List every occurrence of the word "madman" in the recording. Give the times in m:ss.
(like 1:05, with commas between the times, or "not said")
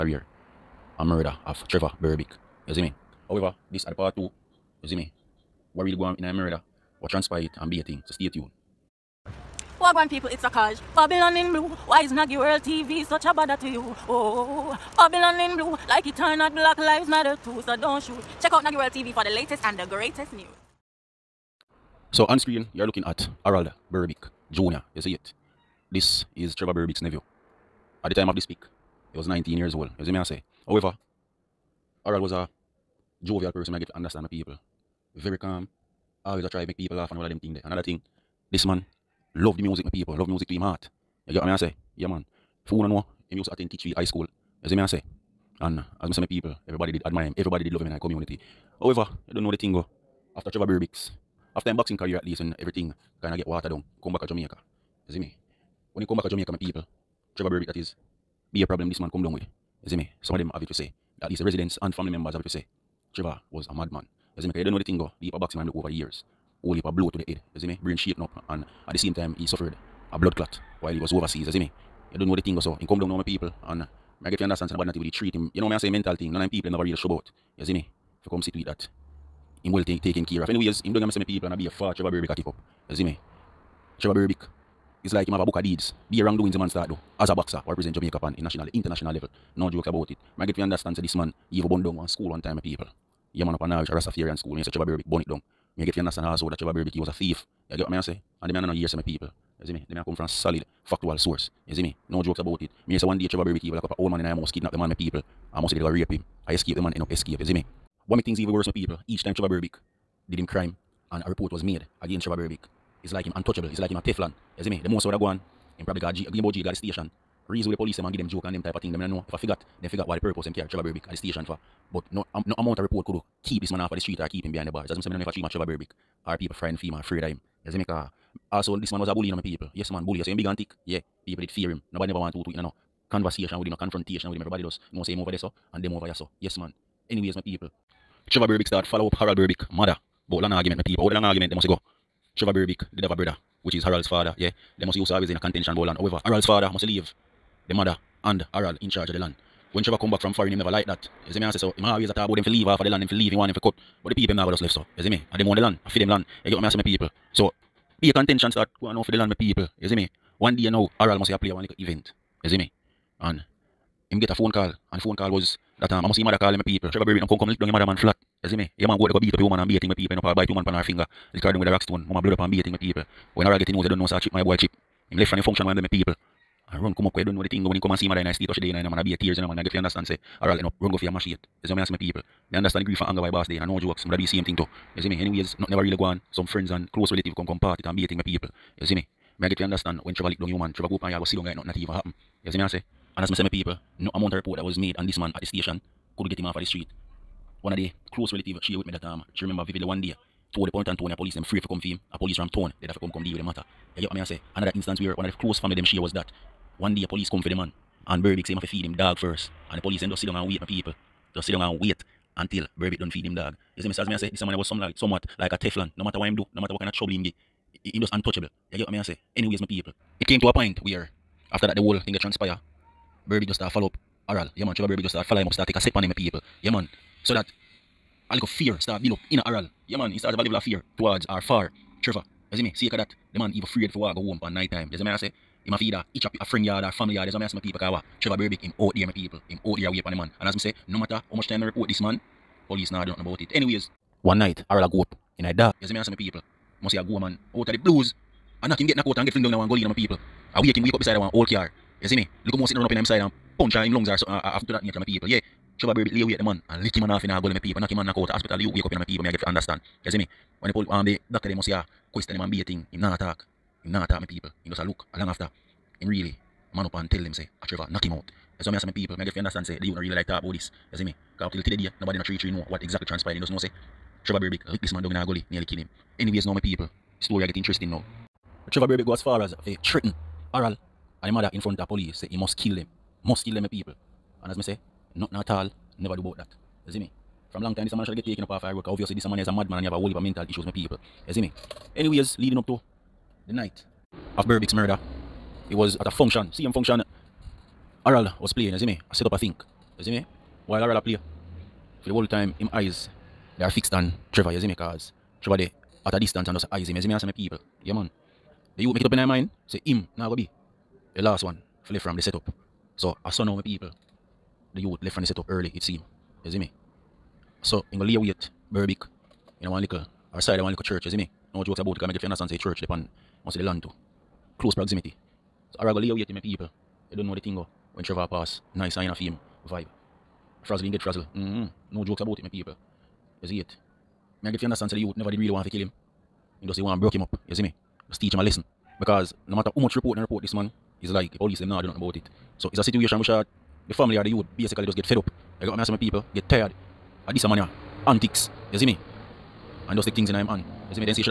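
1:03, 4:49.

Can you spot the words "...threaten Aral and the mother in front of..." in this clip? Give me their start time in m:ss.
4:39.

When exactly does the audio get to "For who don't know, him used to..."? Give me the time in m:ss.
0:42.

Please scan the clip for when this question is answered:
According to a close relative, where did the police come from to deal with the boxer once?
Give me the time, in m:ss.
3:22.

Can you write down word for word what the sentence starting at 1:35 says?
Me get to understand also that Trevor Berbick he was a thief.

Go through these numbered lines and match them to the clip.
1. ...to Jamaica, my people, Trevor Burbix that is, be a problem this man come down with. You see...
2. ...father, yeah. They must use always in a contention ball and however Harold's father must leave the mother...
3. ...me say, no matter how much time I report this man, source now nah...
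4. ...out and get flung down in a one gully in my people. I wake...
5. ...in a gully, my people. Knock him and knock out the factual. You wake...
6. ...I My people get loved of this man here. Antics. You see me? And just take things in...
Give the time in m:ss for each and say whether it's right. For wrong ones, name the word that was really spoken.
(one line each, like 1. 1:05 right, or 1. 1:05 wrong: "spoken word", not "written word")
1. 0:56 right
2. 2:24 right
3. 4:00 wrong: "police", not "source"
4. 4:09 right
5. 4:17 wrong: "hospital", not "factual"
6. 5:45 wrong: "tired", not "loved".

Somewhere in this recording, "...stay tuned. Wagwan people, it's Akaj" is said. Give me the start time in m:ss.
0:08.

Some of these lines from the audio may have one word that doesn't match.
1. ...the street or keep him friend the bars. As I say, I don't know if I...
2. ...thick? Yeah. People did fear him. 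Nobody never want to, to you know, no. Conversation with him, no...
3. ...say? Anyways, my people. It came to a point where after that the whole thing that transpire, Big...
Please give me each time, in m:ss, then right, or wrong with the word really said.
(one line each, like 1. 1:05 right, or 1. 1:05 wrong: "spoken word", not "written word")
1. 2:03 wrong: "behind", not "friend"
2. 2:10 right
3. 3:39 right.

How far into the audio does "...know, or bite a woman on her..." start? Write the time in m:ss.
2:50.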